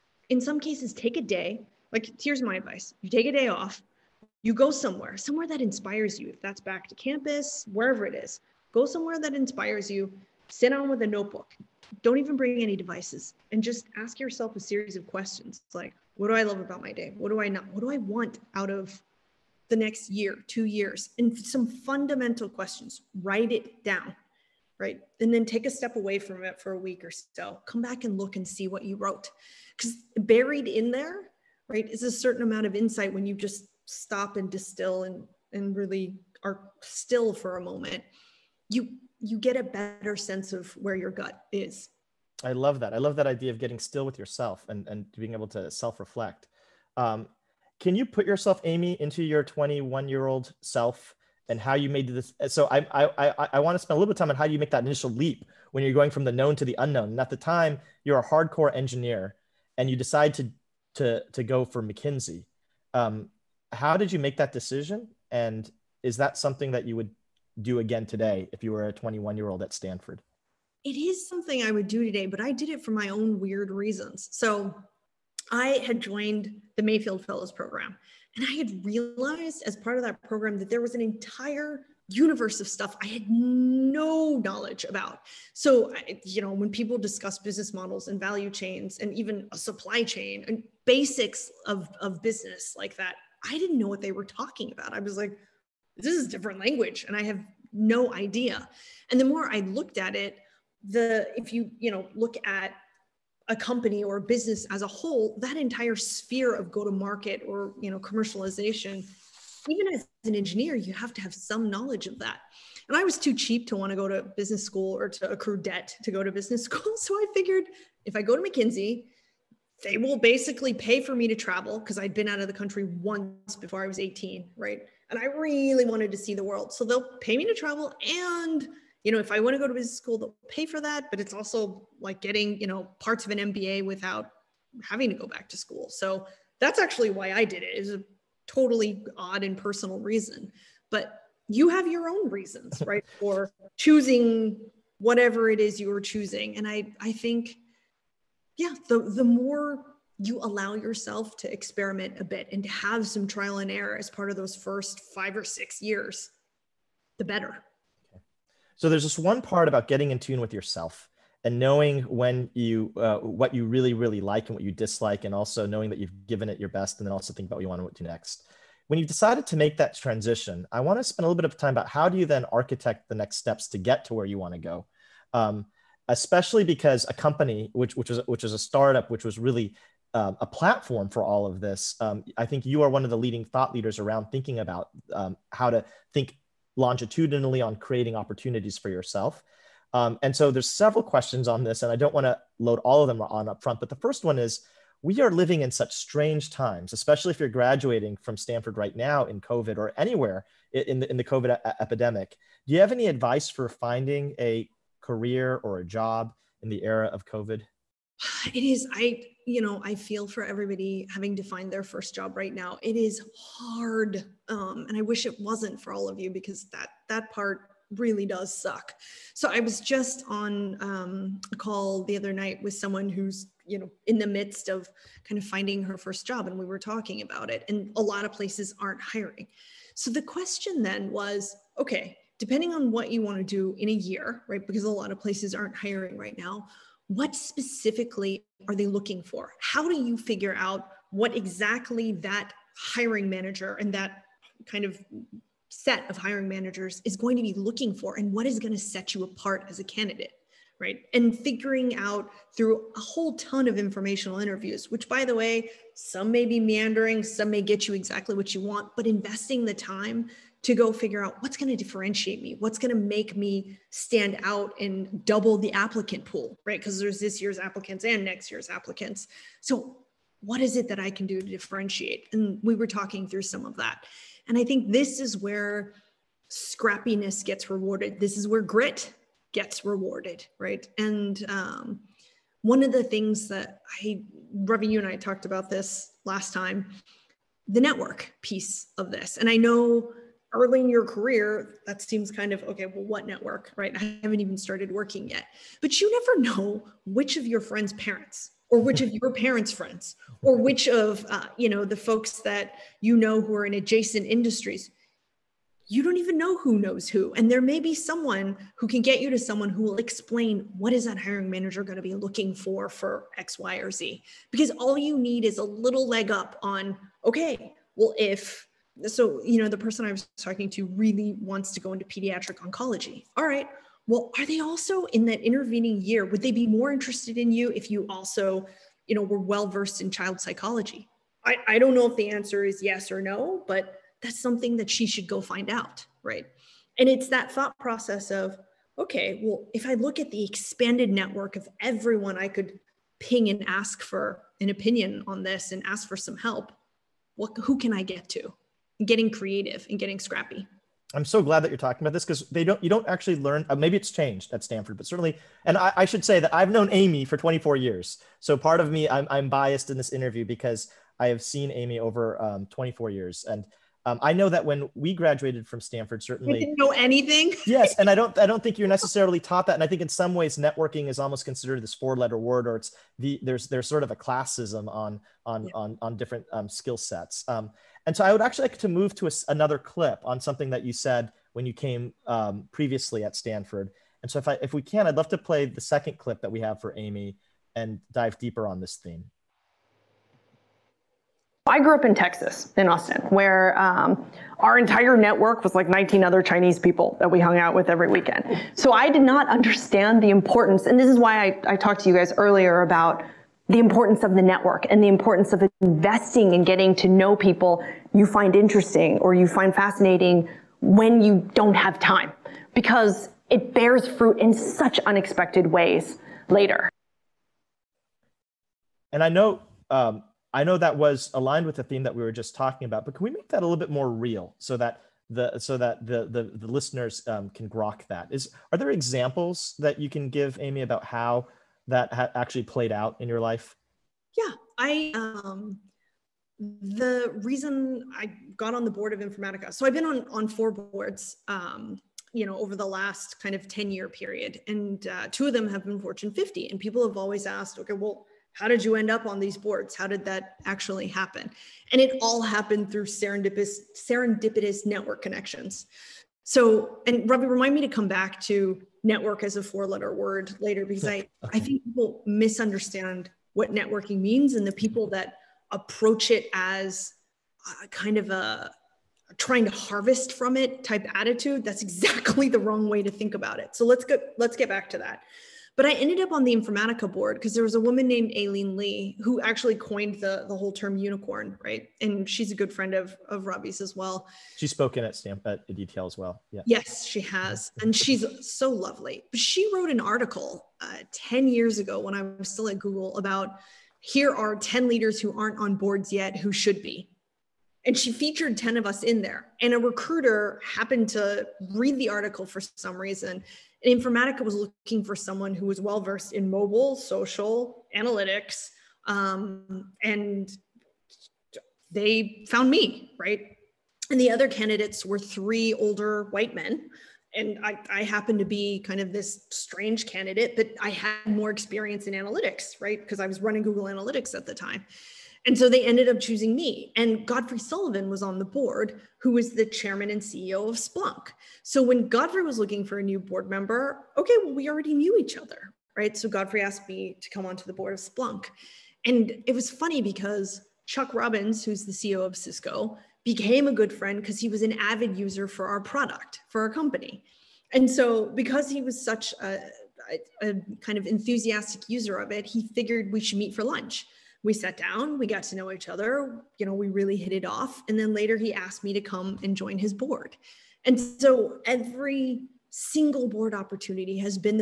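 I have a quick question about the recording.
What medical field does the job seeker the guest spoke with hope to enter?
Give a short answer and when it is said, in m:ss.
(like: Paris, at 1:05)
Pediatric oncology, at 5:22.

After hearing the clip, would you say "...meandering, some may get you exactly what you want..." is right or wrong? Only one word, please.
right.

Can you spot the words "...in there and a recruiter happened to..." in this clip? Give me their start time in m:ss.
8:19.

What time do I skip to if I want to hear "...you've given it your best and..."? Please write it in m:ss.
2:45.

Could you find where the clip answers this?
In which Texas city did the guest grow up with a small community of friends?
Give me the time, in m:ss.
6:32.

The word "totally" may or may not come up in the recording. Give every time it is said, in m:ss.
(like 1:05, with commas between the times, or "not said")
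2:18.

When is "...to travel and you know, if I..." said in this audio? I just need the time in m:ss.
2:07.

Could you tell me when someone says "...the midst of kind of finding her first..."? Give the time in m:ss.
3:44.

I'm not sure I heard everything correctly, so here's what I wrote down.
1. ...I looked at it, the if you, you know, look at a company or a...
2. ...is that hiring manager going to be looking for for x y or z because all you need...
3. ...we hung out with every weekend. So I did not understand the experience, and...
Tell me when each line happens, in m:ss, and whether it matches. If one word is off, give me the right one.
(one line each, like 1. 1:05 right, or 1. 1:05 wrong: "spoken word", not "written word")
1. 1:39 right
2. 5:10 right
3. 6:37 wrong: "importance", not "experience".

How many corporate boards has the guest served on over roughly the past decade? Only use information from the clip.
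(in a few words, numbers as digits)
4.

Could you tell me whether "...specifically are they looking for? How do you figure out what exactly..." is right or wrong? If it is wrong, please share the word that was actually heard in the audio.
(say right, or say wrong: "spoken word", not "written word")
right.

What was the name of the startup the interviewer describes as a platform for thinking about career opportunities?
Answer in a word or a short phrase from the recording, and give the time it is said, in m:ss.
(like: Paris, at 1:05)
Accompany, at 2:57.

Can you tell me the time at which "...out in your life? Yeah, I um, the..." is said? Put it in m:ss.
7:12.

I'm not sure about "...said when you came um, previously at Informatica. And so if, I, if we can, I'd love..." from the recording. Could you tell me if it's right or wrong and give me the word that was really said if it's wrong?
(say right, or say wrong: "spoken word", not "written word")
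wrong: "Stanford", not "Informatica".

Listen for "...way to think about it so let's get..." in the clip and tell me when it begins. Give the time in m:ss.
7:52.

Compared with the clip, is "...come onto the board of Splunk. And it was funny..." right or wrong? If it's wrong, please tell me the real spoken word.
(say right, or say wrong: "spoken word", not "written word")
right.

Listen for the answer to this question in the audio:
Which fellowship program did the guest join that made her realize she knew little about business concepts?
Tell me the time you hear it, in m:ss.
1:16.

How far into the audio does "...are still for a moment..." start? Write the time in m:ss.
0:36.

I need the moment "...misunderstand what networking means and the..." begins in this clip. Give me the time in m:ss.
7:42.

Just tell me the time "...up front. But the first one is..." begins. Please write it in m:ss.
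3:13.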